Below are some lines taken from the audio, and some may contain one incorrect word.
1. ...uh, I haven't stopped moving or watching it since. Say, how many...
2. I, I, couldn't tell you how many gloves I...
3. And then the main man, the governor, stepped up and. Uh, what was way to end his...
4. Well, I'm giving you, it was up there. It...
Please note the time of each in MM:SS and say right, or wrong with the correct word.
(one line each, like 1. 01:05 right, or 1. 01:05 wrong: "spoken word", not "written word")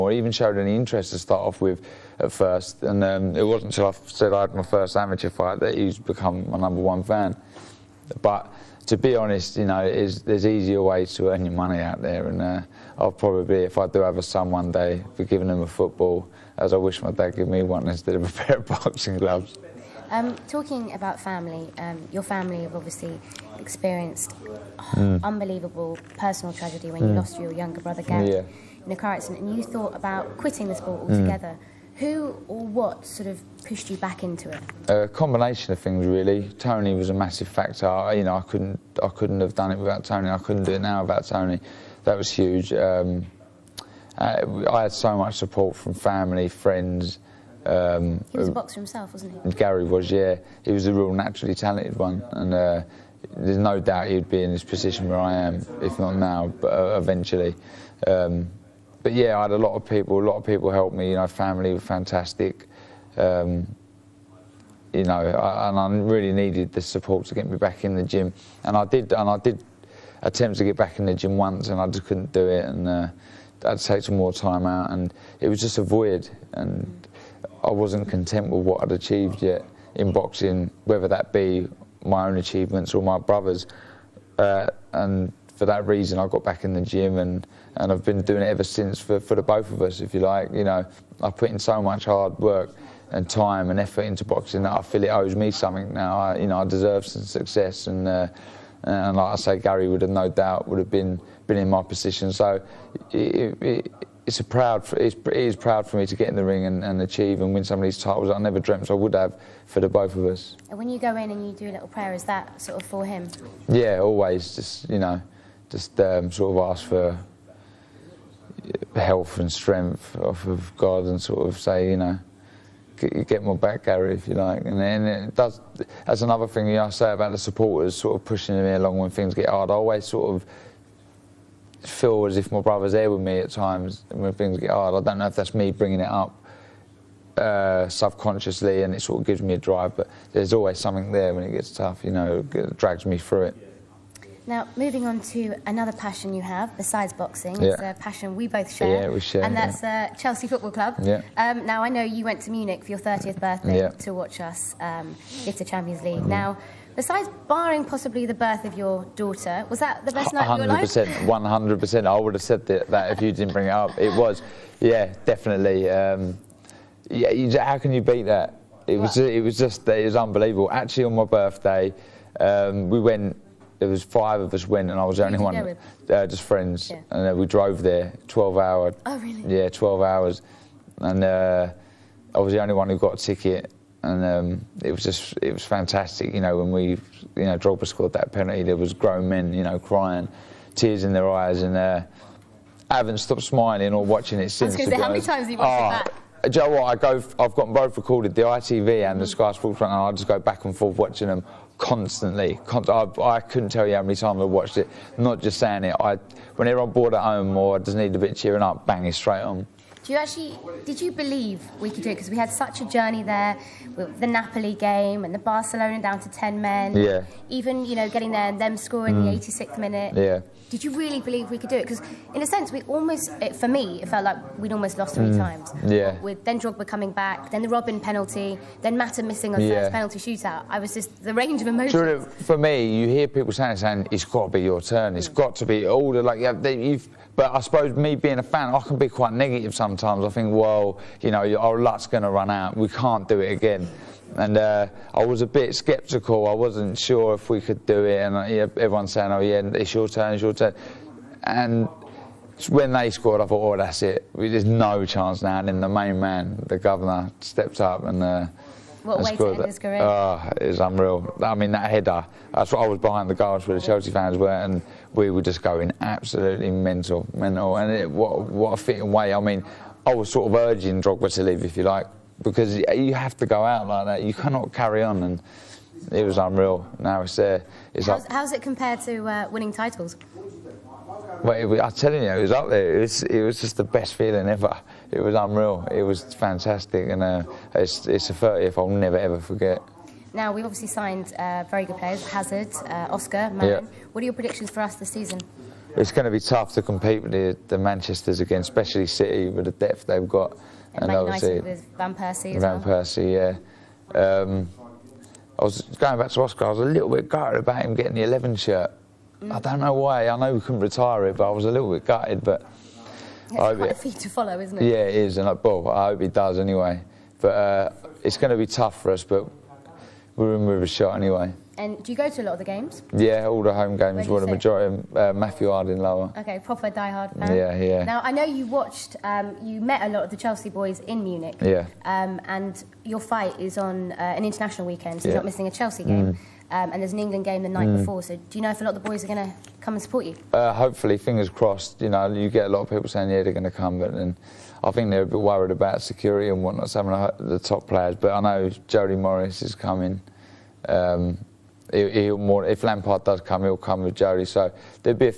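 1. 03:11 wrong: "smiling", not "moving"
2. 03:22 wrong: "times", not "gloves"
3. 04:15 right
4. 04:41 wrong: "telling", not "giving".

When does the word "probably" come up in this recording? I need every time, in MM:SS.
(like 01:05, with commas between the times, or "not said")
00:13.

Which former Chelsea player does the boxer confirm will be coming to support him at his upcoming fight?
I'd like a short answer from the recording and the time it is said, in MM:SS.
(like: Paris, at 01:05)
Jody Morris, at 05:48.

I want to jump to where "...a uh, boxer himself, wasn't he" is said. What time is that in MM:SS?
00:48.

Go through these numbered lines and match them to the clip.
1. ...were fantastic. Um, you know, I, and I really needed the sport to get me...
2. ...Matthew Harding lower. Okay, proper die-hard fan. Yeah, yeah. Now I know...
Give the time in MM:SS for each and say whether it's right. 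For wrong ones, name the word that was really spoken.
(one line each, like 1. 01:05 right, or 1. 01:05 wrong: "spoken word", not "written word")
1. 01:01 wrong: "support", not "sport"
2. 05:25 right.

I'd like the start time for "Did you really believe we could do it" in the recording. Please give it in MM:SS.
03:40.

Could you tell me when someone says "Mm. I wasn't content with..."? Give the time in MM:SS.
01:16.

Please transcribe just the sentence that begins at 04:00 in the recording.
I think, well, you know, our luck's going to run out.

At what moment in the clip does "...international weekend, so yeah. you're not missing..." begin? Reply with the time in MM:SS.
05:34.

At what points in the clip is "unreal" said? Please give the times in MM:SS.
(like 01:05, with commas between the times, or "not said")
04:20, 04:36, 04:45.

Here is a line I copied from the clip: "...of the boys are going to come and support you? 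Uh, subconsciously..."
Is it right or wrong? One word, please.
wrong.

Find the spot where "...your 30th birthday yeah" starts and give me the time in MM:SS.
02:32.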